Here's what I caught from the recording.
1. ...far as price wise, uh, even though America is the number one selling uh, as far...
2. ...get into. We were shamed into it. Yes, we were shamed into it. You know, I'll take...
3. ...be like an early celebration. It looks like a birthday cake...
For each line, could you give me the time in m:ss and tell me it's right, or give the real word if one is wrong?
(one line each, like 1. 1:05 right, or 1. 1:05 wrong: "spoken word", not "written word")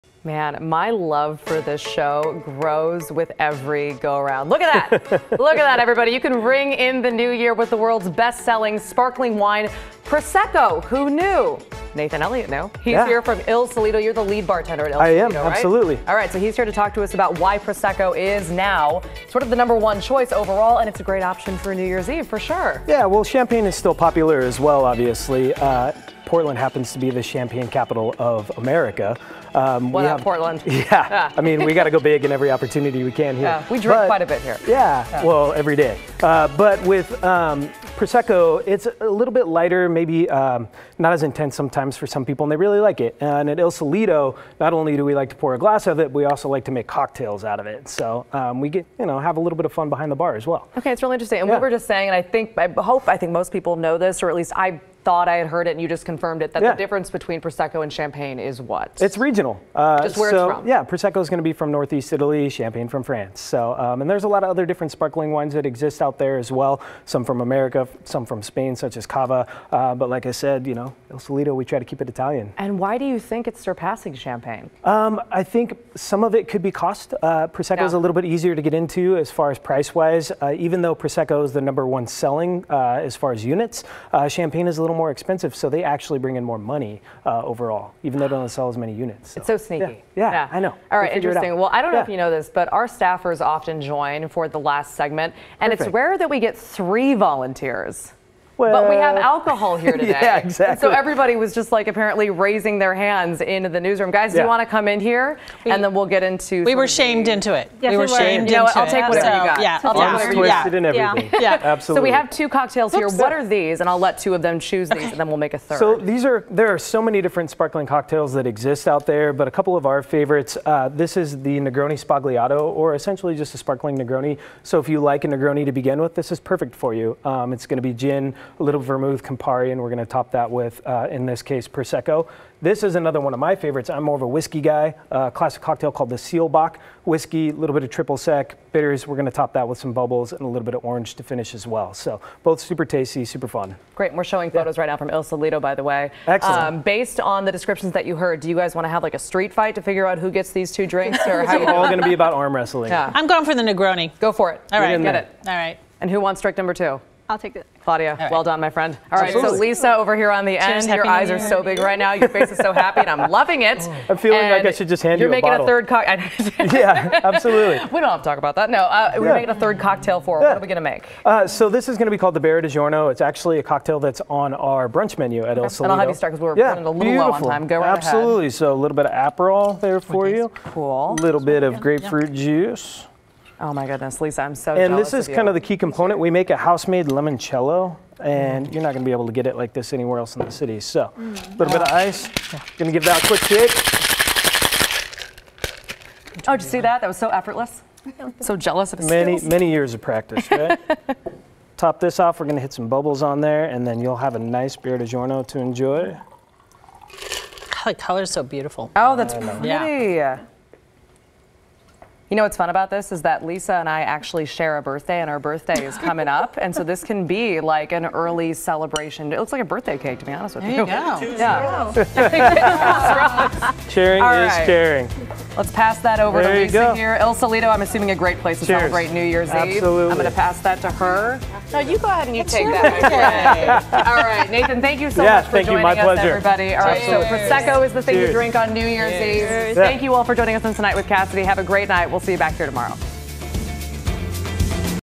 1. 1:19 wrong: "Prosecco", not "America"
2. 1:46 right
3. 3:37 right.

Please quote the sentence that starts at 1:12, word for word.
And why do you think it's surpassing Champagne?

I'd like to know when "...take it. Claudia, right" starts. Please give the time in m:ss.
2:37.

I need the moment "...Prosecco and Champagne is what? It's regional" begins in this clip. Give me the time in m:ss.
0:57.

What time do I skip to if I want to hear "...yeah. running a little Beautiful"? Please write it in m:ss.
2:56.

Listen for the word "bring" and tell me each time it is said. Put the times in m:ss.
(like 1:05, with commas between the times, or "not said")
1:26.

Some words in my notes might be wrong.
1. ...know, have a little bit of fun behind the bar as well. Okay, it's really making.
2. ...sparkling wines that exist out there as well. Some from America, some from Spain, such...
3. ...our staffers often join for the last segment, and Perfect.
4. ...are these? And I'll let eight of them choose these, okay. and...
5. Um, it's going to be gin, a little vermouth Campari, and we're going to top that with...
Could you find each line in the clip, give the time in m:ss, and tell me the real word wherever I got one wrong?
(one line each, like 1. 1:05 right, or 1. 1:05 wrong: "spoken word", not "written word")
1. 0:49 wrong: "interesting", not "making"
2. 1:04 right
3. 1:32 right
4. 1:53 wrong: "two", not "eight"
5. 2:07 right.